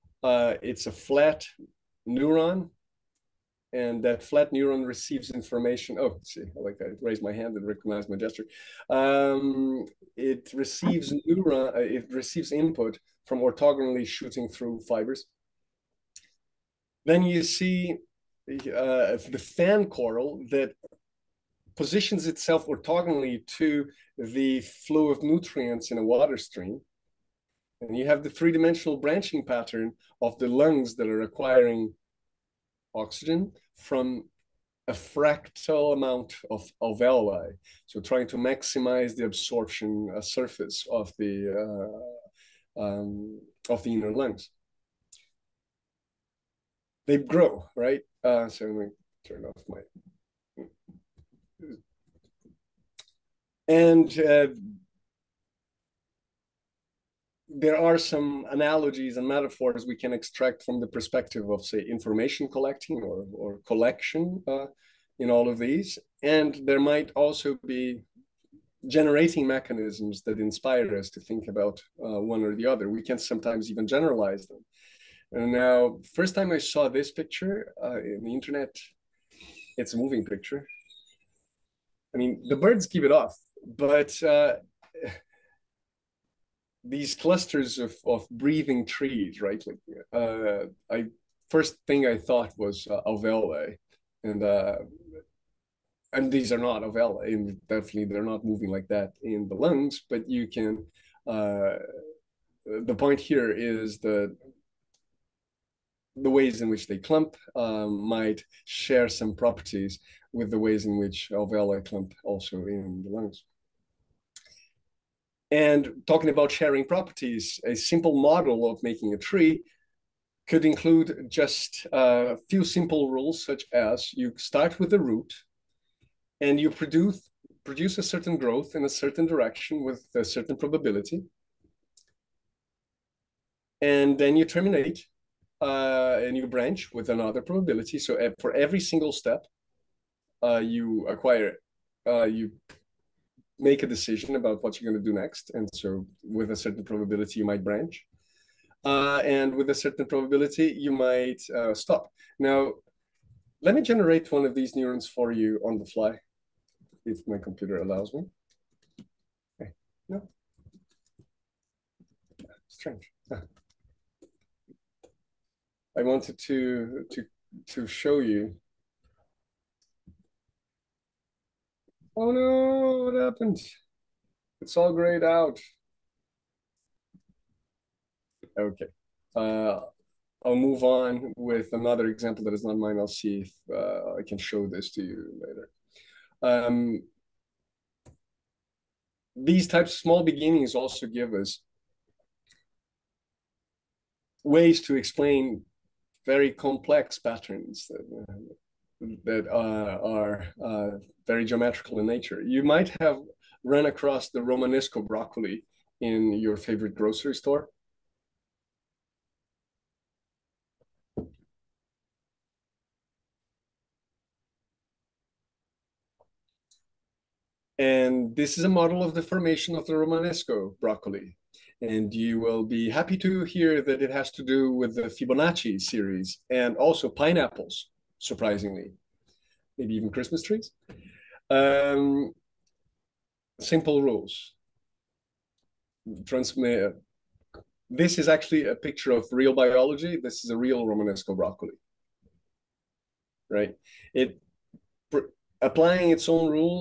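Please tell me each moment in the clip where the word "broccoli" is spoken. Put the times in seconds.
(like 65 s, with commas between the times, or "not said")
205 s, 220 s, 241 s.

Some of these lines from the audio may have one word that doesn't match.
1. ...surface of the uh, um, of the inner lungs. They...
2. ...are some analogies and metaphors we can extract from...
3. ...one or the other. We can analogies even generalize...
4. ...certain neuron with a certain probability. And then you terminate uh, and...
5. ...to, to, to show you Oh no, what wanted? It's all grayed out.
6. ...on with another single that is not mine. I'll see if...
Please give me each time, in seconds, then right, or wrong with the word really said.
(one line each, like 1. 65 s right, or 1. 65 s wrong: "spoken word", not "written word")
1. 40 s right
2. 57 s right
3. 72 s wrong: "sometimes", not "analogies"
4. 128 s wrong: "direction", not "neuron"
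5. 166 s wrong: "happened", not "wanted"
6. 180 s wrong: "example", not "single".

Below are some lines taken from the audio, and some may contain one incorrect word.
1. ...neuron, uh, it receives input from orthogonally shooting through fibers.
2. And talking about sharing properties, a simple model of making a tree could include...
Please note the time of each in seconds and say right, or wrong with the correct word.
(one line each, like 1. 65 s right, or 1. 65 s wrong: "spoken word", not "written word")
1. 11 s right
2. 115 s right.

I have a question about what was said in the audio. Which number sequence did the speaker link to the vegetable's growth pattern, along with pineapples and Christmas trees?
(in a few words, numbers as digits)
Fibonacci series.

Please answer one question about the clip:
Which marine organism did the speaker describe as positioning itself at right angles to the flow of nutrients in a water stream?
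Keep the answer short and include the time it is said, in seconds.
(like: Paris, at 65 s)
fan coral, at 19 s.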